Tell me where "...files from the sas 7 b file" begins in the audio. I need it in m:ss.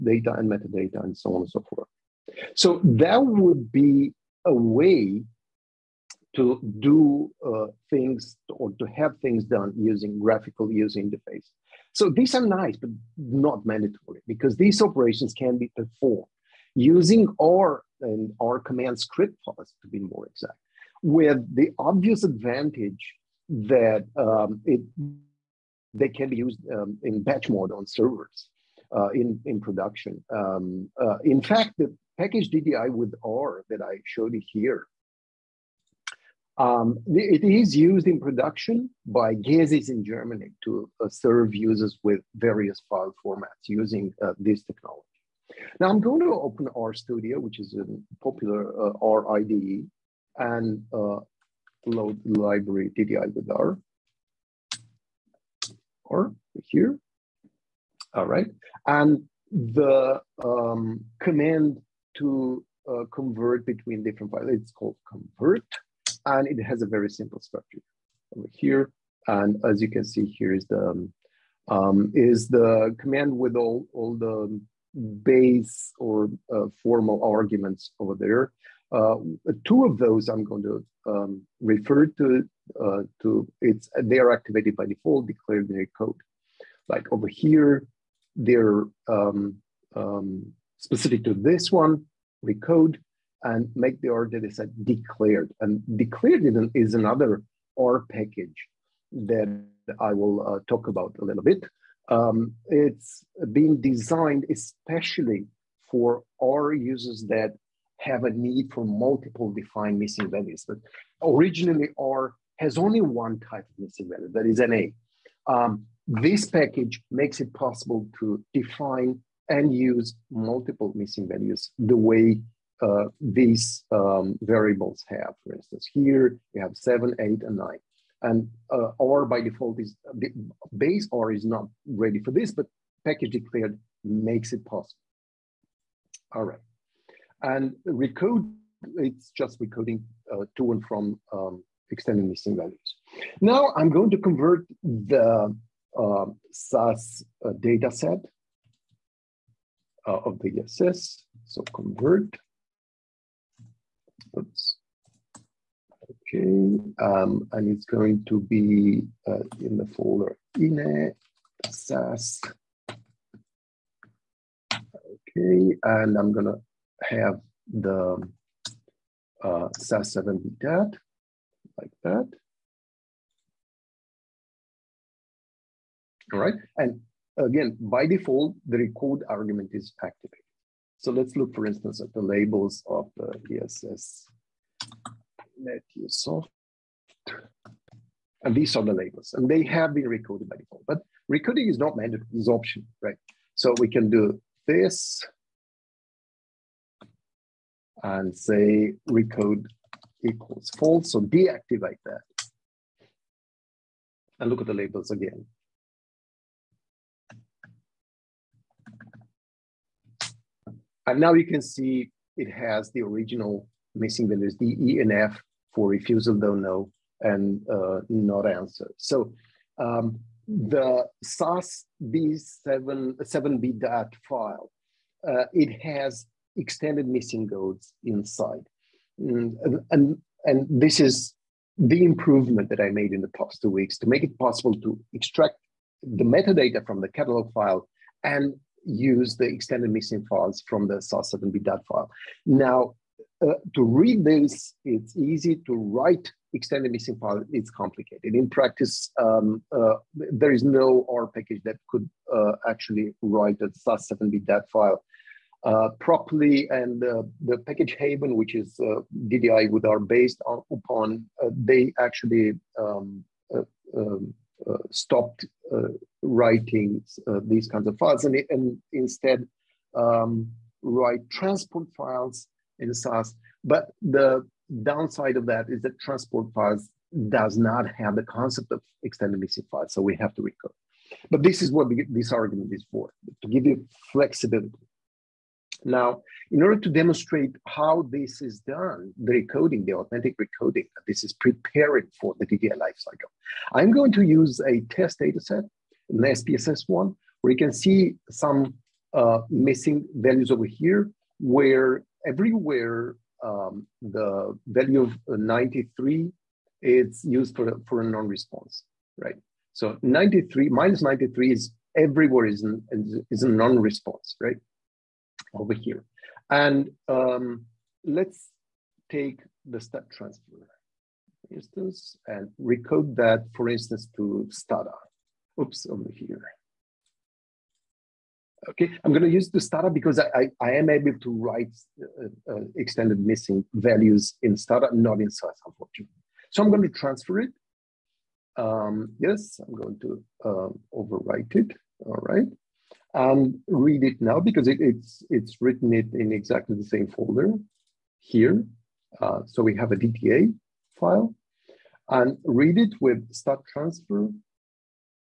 4:00.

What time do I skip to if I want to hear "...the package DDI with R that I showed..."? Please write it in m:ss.
0:31.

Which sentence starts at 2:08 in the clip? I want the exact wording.
And uh, or by default is base or is not ready for this, but package declared makes it possible.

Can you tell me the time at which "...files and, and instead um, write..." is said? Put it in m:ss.
4:27.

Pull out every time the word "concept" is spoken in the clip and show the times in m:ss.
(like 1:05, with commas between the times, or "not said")
4:38.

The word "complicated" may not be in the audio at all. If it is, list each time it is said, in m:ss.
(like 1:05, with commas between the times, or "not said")
4:07.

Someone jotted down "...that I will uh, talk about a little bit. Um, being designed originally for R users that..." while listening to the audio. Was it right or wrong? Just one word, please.
wrong.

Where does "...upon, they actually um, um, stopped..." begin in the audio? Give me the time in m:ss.
4:20.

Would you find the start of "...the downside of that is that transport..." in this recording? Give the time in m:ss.
4:34.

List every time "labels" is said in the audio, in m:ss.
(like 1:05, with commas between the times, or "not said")
3:02, 3:08, 3:24.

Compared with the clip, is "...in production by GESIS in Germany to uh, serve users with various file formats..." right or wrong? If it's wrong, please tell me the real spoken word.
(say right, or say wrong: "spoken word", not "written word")
right.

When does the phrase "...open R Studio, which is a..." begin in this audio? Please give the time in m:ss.
0:46.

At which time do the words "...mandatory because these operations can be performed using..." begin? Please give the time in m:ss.
0:13.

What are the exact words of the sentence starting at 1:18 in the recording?
Uh, two of those I'm going to um, refer to.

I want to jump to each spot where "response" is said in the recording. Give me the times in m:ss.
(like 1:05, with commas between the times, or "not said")
5:08, 5:13.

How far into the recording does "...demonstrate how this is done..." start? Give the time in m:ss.
4:46.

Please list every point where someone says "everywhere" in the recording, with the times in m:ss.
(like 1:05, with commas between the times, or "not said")
5:02, 5:11.